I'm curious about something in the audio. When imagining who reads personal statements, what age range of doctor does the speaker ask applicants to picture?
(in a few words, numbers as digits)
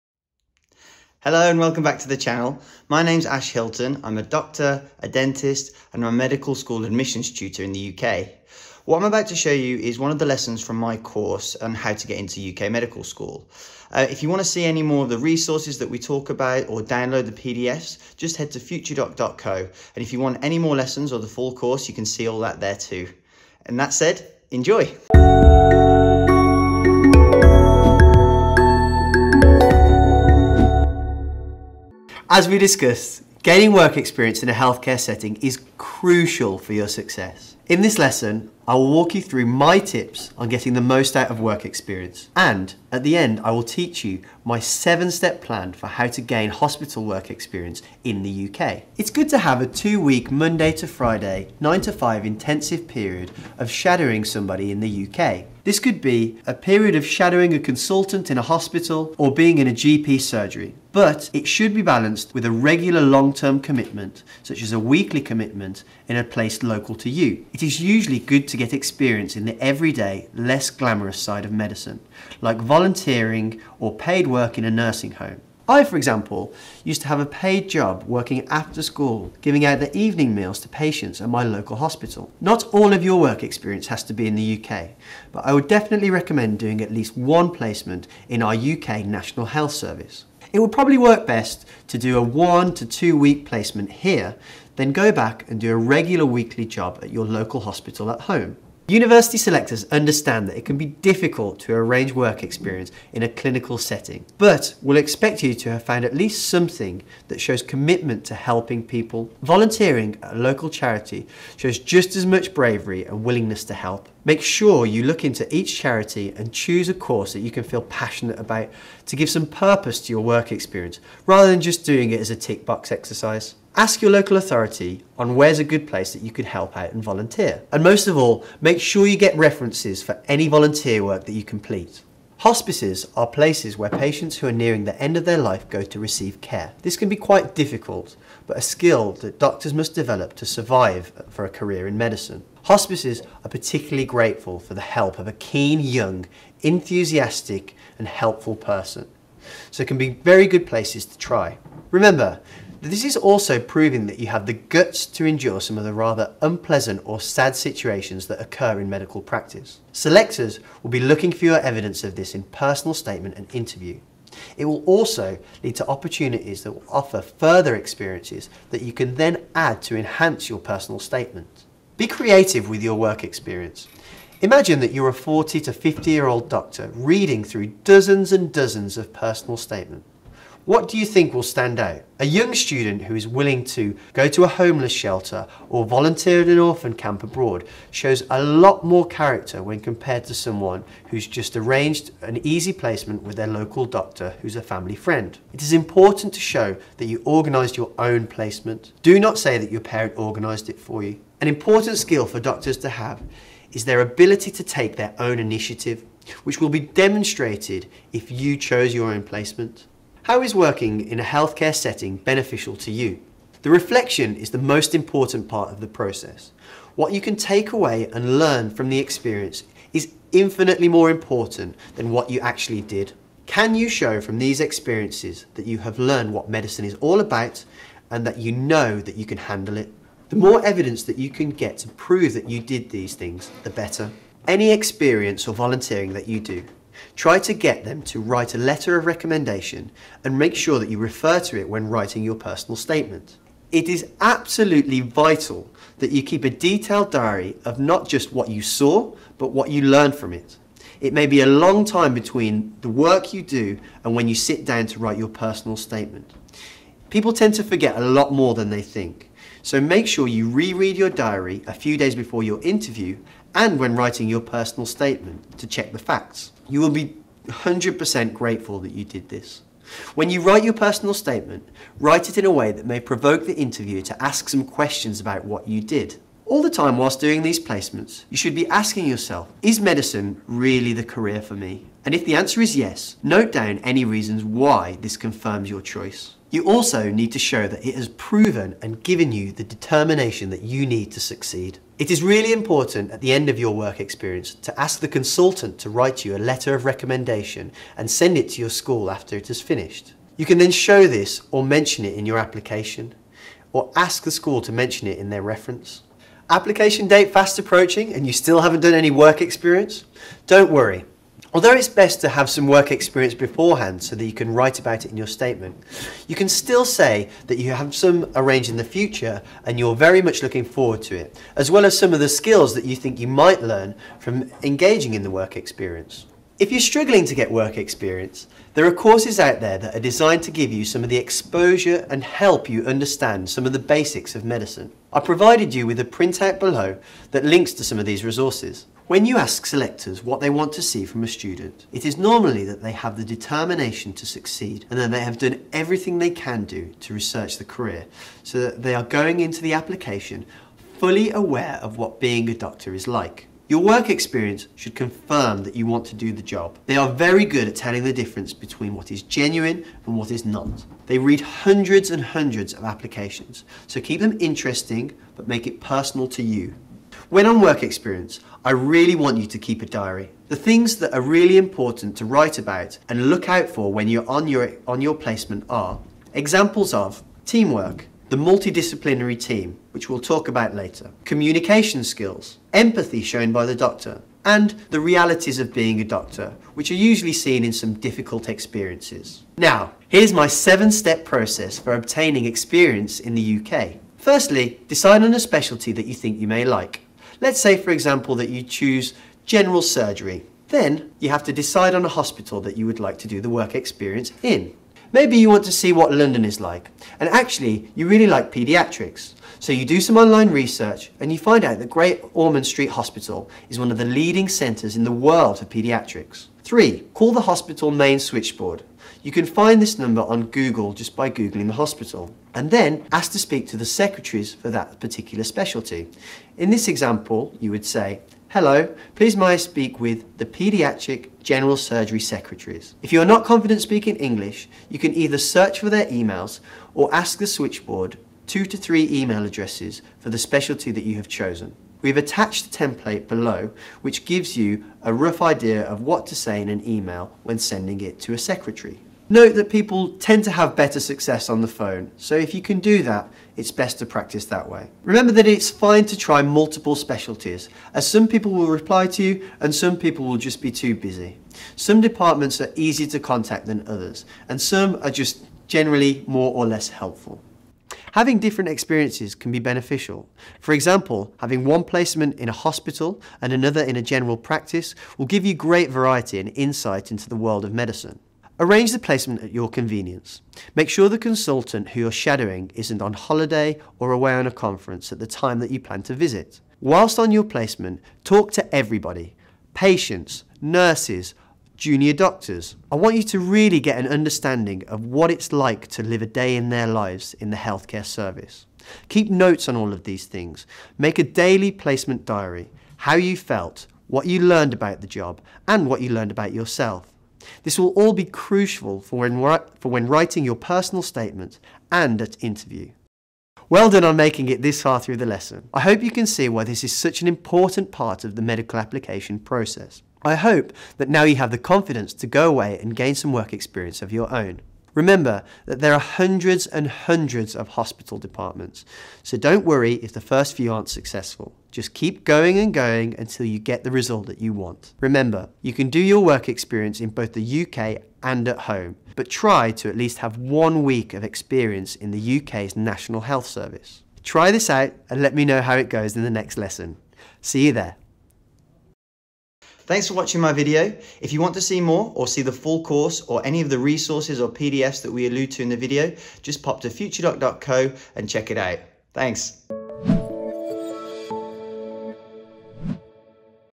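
40 to 50.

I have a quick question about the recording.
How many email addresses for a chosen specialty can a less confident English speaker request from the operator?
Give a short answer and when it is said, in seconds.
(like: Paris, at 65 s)
2 to 3, at 438 s.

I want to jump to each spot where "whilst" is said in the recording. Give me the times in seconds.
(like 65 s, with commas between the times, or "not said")
276 s, 486 s.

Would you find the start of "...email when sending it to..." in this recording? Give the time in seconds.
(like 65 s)
446 s.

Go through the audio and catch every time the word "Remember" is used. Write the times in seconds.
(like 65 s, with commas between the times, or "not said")
151 s, 455 s, 524 s, 534 s.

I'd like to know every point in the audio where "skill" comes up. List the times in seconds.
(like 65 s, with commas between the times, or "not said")
138 s, 201 s, 322 s, 382 s.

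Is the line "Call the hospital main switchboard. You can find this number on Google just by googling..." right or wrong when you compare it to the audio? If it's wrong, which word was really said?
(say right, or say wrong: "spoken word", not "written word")
right.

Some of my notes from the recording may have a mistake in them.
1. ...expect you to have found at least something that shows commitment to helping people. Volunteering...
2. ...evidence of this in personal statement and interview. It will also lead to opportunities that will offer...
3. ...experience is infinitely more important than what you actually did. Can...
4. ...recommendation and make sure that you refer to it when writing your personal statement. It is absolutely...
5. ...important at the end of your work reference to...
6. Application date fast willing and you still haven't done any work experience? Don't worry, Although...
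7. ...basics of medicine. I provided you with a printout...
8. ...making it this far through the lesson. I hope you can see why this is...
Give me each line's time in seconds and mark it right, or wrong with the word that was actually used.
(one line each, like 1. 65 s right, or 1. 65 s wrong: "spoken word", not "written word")
1. 104 s right
2. 161 s right
3. 218 s right
4. 239 s right
5. 292 s wrong: "experience", not "reference"
6. 306 s wrong: "approaching", not "willing"
7. 333 s right
8. 514 s right.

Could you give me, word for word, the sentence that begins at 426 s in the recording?
In this example, you would say, Hello, please may I speak with the Paediatric General Surgery Secretaries.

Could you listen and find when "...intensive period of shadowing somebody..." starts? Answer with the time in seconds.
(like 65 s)
52 s.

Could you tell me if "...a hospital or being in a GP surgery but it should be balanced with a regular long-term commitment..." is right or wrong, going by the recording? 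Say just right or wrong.
right.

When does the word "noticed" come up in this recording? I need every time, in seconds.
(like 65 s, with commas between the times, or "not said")
not said.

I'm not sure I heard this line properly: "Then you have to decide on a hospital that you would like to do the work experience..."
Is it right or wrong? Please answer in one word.
right.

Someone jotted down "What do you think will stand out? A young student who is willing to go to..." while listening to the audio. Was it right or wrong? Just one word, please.
right.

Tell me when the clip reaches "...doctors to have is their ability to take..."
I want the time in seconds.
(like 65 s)
202 s.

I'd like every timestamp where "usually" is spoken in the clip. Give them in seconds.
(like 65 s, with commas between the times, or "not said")
67 s, 387 s.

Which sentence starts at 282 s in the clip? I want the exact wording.
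And if the answer is yes, note down any reasons why this confirms your choice.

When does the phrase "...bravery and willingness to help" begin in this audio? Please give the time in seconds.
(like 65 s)
112 s.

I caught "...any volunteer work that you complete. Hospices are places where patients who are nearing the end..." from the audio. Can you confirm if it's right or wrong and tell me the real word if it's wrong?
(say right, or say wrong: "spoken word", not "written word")
right.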